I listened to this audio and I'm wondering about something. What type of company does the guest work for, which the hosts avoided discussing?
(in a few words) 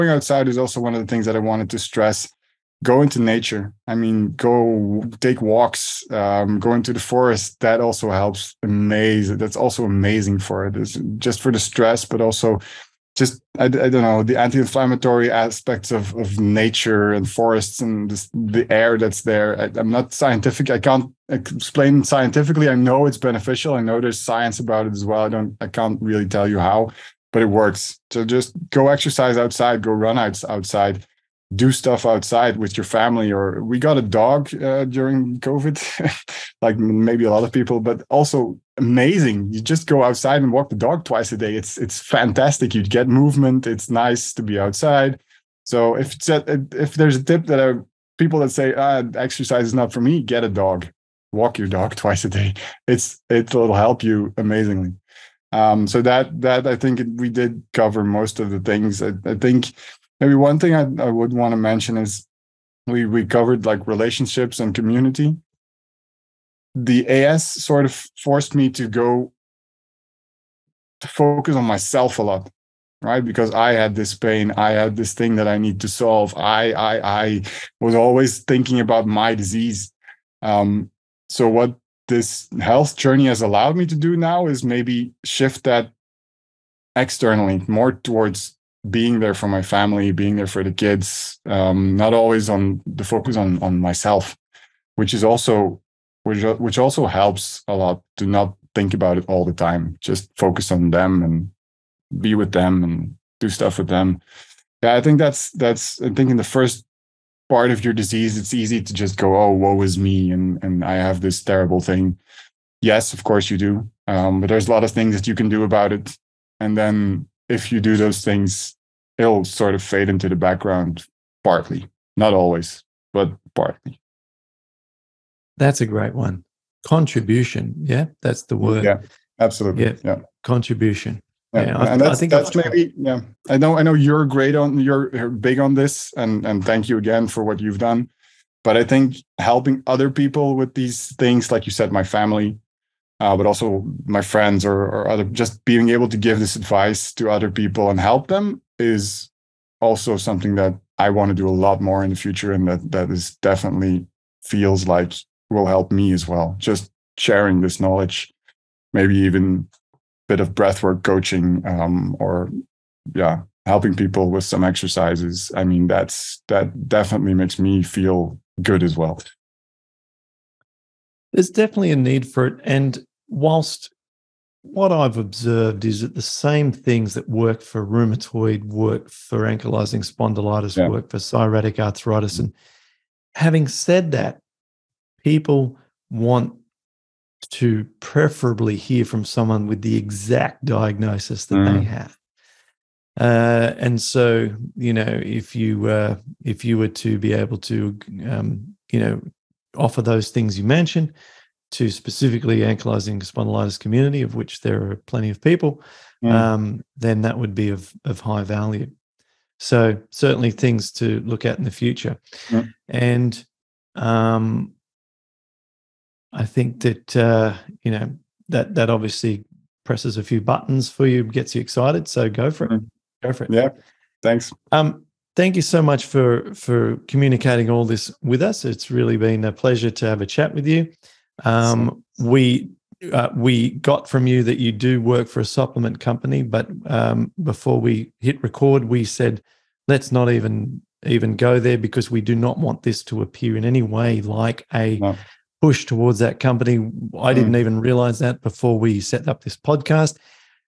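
A supplement company.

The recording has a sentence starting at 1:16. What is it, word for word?
I I I was always thinking about my disease.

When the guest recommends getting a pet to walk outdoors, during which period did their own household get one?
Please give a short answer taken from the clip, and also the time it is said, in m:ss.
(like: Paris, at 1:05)
During COVID, at 0:34.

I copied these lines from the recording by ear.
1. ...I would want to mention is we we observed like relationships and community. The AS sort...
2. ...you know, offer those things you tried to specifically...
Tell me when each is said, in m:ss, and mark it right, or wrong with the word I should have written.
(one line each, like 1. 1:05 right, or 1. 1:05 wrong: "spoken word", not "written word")
1. 1:01 wrong: "covered", not "observed"
2. 3:18 wrong: "mentioned", not "tried".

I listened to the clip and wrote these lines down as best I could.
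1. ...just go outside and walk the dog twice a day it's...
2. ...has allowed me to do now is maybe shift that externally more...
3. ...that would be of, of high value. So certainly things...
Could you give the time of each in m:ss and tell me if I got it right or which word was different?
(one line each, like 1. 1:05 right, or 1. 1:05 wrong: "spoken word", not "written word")
1. 0:39 right
2. 1:23 right
3. 3:27 right.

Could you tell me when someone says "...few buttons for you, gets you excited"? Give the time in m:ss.
3:40.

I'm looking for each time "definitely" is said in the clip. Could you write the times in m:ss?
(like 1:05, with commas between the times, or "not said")
2:33, 2:46, 2:51.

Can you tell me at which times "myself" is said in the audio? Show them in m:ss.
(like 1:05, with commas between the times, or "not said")
1:11, 1:33.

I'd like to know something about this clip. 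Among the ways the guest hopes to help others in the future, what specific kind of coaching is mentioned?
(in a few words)
Breathwork coaching.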